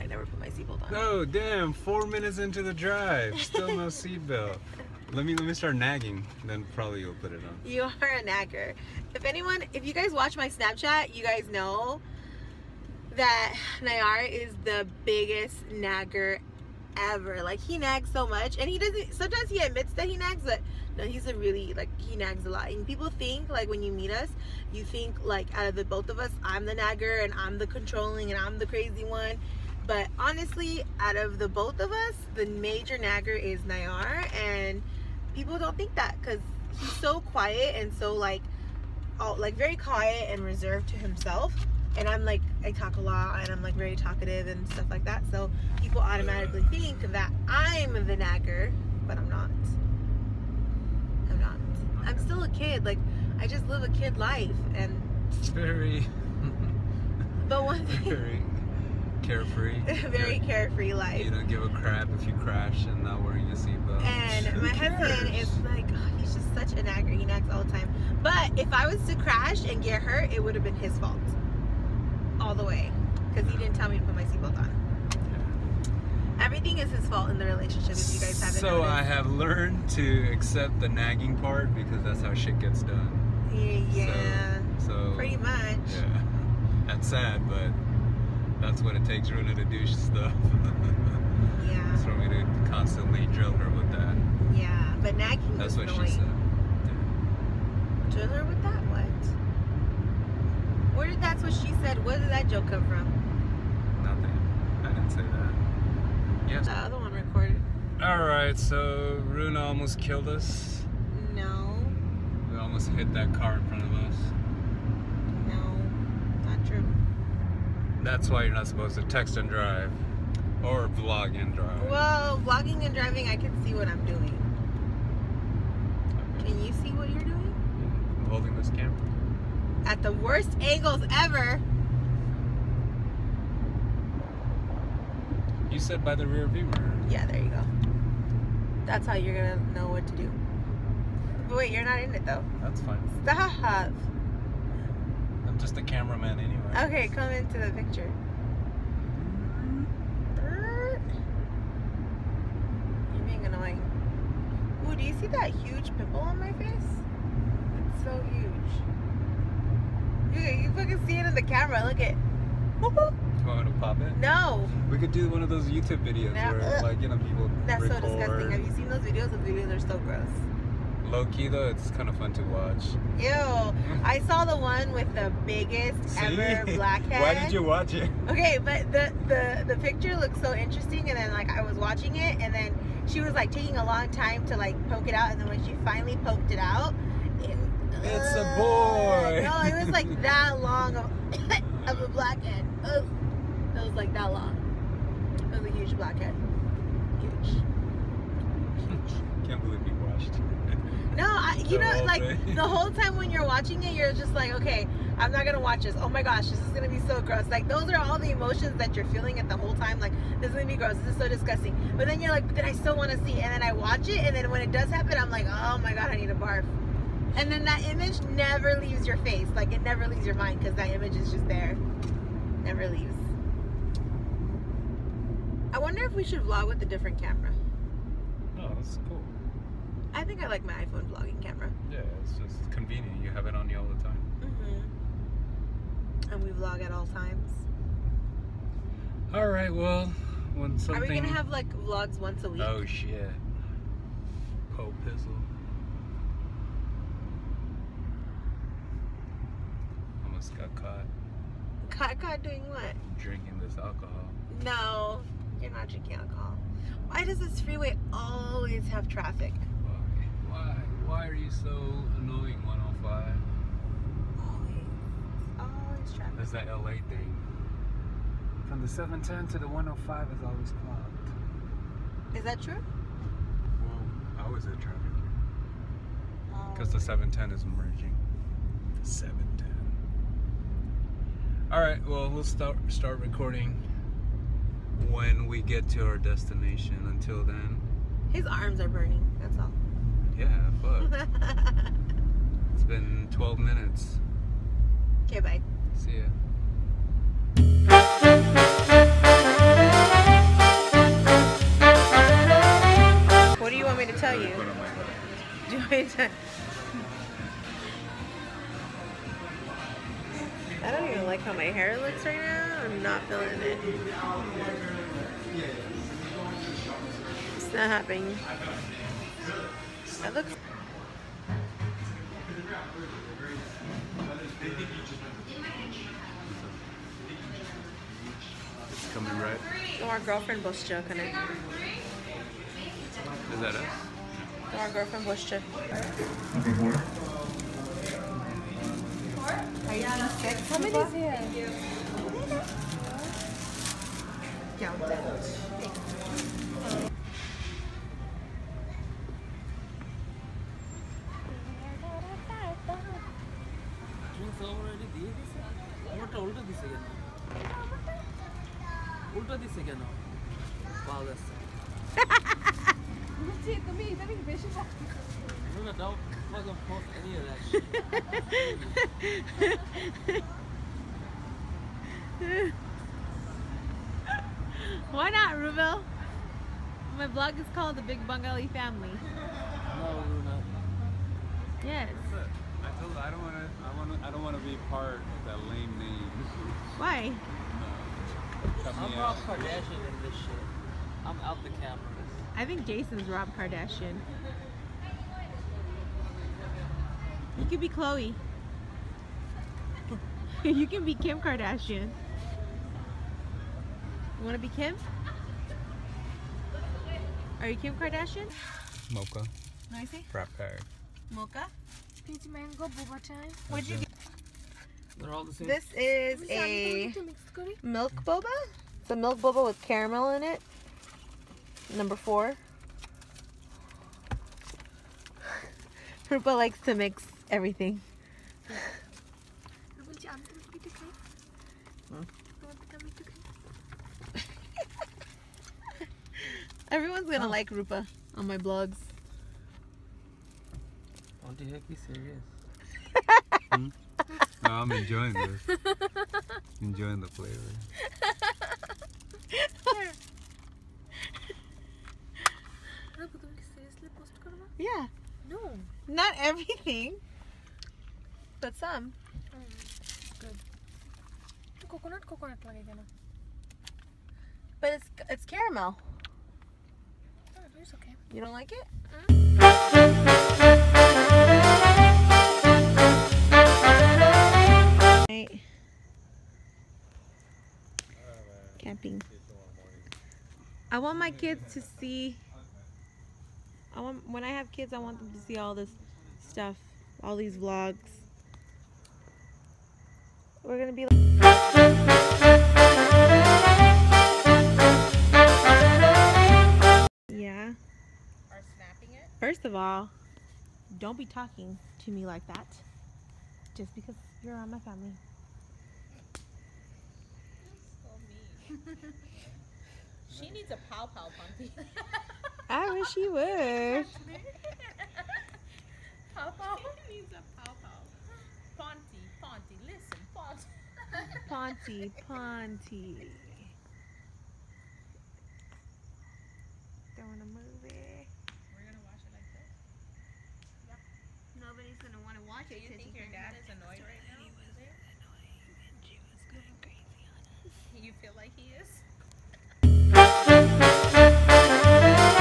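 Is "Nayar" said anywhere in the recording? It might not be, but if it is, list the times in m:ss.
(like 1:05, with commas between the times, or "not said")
0:13, 0:33.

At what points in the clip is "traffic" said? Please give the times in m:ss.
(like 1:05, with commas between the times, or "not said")
4:19, 4:26, 4:34.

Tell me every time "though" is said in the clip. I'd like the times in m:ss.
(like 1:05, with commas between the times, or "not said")
2:22, 2:51.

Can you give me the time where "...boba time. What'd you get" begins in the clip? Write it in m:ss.
6:52.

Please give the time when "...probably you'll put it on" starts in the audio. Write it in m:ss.
0:06.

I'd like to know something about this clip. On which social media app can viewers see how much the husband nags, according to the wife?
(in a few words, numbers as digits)
Snapchat.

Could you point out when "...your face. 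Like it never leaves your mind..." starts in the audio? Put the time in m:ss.
3:39.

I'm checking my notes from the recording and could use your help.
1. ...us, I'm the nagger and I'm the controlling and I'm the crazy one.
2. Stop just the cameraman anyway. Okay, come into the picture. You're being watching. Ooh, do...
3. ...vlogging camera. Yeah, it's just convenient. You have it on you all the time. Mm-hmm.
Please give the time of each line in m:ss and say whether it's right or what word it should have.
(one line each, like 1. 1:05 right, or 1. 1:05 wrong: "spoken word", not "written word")
1. 0:26 right
2. 2:23 wrong: "annoying", not "watching"
3. 3:51 right.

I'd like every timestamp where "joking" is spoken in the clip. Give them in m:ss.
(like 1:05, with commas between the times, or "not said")
5:30, 5:35.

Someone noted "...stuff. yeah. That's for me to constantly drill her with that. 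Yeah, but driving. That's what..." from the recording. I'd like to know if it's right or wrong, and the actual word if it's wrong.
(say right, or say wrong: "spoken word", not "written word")
wrong: "nagging", not "driving".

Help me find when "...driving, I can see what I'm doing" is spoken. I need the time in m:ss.
2:02.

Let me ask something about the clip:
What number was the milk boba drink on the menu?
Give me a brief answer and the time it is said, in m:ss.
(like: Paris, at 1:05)
4, at 7:01.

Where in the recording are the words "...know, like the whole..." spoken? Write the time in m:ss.
3:21.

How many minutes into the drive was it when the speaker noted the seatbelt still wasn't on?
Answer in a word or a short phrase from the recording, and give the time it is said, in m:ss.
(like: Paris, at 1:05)
4, at 0:01.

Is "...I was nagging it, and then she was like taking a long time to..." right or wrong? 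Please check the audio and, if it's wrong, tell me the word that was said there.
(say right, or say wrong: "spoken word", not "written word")
wrong: "watching", not "nagging".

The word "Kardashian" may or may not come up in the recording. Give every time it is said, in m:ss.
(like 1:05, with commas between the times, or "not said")
6:29, 6:33, 6:41, 6:47.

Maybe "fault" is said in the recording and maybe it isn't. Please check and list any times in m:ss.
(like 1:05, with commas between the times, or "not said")
1:10, 1:17.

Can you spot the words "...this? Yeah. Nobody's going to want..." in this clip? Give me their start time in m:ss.
8:49.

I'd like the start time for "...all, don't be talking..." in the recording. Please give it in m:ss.
8:19.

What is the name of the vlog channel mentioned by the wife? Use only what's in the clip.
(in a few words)
The Big Bengali Family.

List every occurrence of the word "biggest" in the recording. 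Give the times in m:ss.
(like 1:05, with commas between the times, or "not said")
0:15, 2:55.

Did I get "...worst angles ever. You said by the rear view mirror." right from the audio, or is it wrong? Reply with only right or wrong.
right.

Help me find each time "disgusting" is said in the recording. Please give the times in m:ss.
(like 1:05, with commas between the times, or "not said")
2:48, 3:31.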